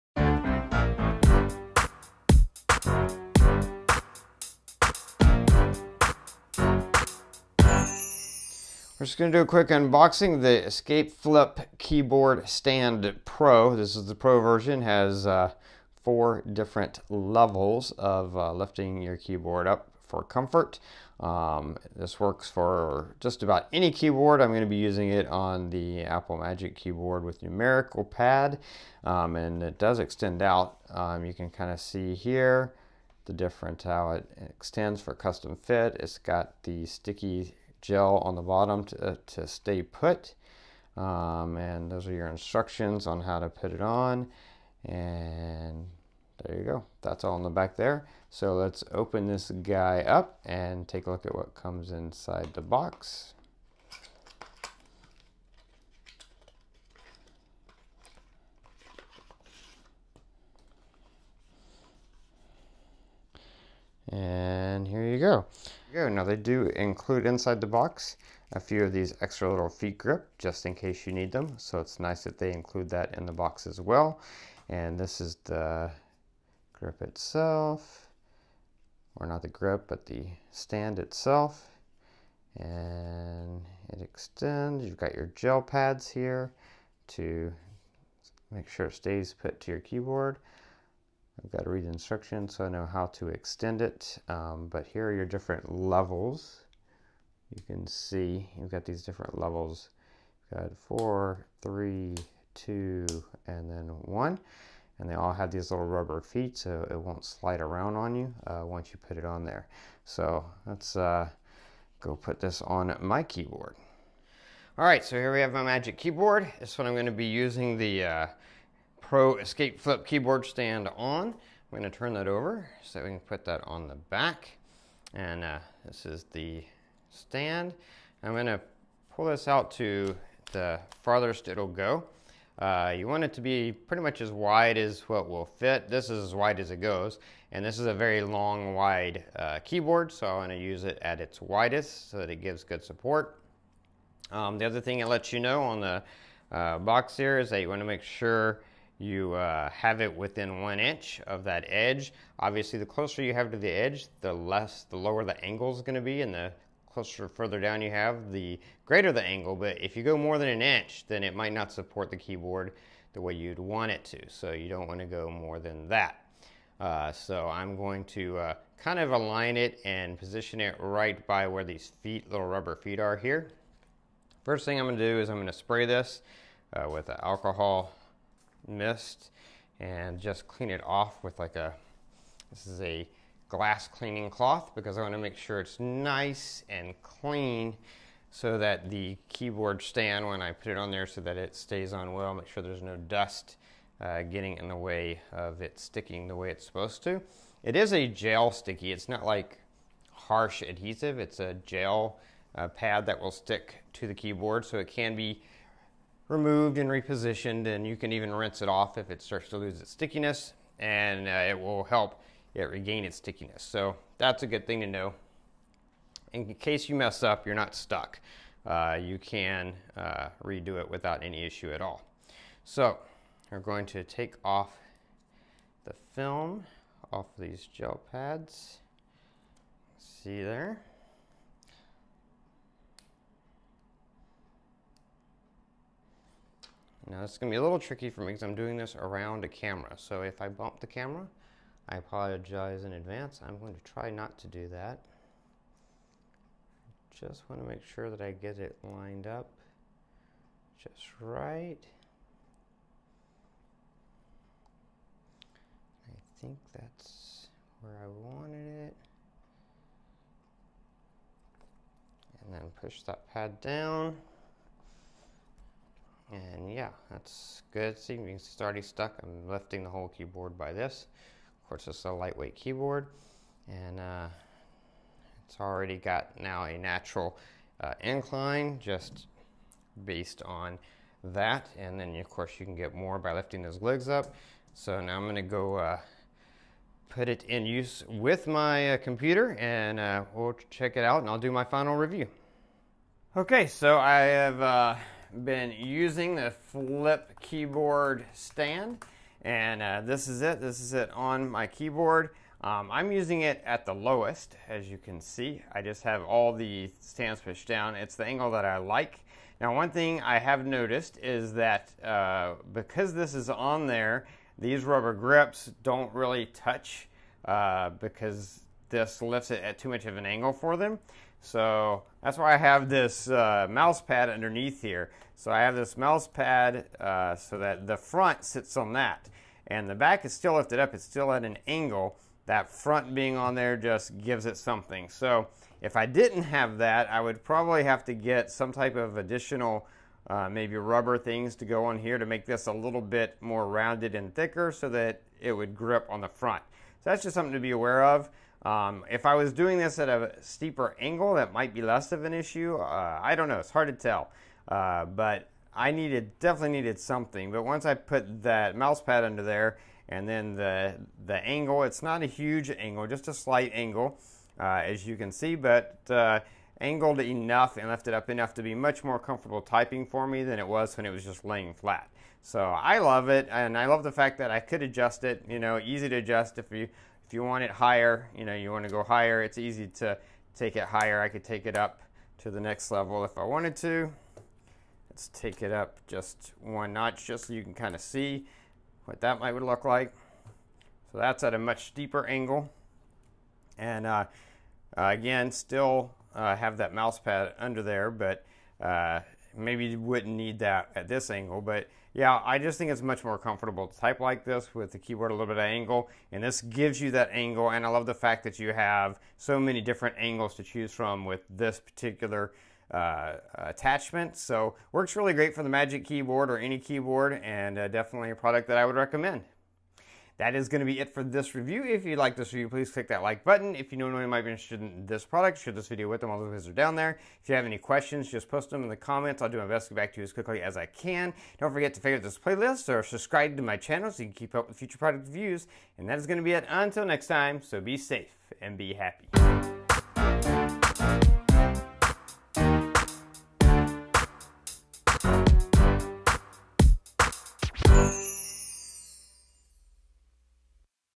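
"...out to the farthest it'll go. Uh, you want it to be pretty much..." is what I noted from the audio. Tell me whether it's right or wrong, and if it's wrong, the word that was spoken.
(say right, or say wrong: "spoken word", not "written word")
right.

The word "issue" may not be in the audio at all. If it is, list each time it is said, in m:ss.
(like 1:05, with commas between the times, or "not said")
3:41, 5:52.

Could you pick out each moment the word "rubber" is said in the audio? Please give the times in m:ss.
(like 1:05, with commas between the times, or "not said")
1:45, 2:52, 5:14, 5:40.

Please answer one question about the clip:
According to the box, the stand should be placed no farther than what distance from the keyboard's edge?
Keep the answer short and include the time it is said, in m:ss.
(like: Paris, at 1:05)
one inch, at 2:30.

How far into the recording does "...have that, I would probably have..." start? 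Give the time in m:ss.
5:36.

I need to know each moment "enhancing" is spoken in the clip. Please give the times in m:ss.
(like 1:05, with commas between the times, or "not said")
not said.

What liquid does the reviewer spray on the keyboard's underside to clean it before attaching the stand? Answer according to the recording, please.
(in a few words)
alcohol mist.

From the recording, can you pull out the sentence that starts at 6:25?
Let's take it up just one notch just so you can kind of see what that might would look like.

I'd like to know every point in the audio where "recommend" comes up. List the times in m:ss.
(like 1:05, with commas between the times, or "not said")
6:58.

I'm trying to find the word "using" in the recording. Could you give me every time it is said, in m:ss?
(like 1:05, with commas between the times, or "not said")
0:24, 1:57, 4:55, 5:03.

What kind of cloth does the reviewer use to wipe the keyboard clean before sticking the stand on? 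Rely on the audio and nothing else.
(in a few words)
glass cleaning cloth.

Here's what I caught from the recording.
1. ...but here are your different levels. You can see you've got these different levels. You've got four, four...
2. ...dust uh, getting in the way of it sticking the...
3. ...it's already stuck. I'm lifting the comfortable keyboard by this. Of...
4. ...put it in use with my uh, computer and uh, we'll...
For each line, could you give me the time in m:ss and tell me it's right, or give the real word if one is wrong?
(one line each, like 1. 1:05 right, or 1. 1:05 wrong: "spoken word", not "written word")
1. 1:34 wrong: "three", not "four"
2. 3:12 right
3. 4:28 wrong: "whole", not "comfortable"
4. 4:47 right.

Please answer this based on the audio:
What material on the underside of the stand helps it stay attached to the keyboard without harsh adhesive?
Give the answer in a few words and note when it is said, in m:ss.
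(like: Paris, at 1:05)
sticky gel, at 0:36.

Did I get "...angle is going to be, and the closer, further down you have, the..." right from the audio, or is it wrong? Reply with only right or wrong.
right.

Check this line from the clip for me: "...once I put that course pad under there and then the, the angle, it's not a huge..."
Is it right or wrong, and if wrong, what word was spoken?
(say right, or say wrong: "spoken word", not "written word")
wrong: "mouse", not "course".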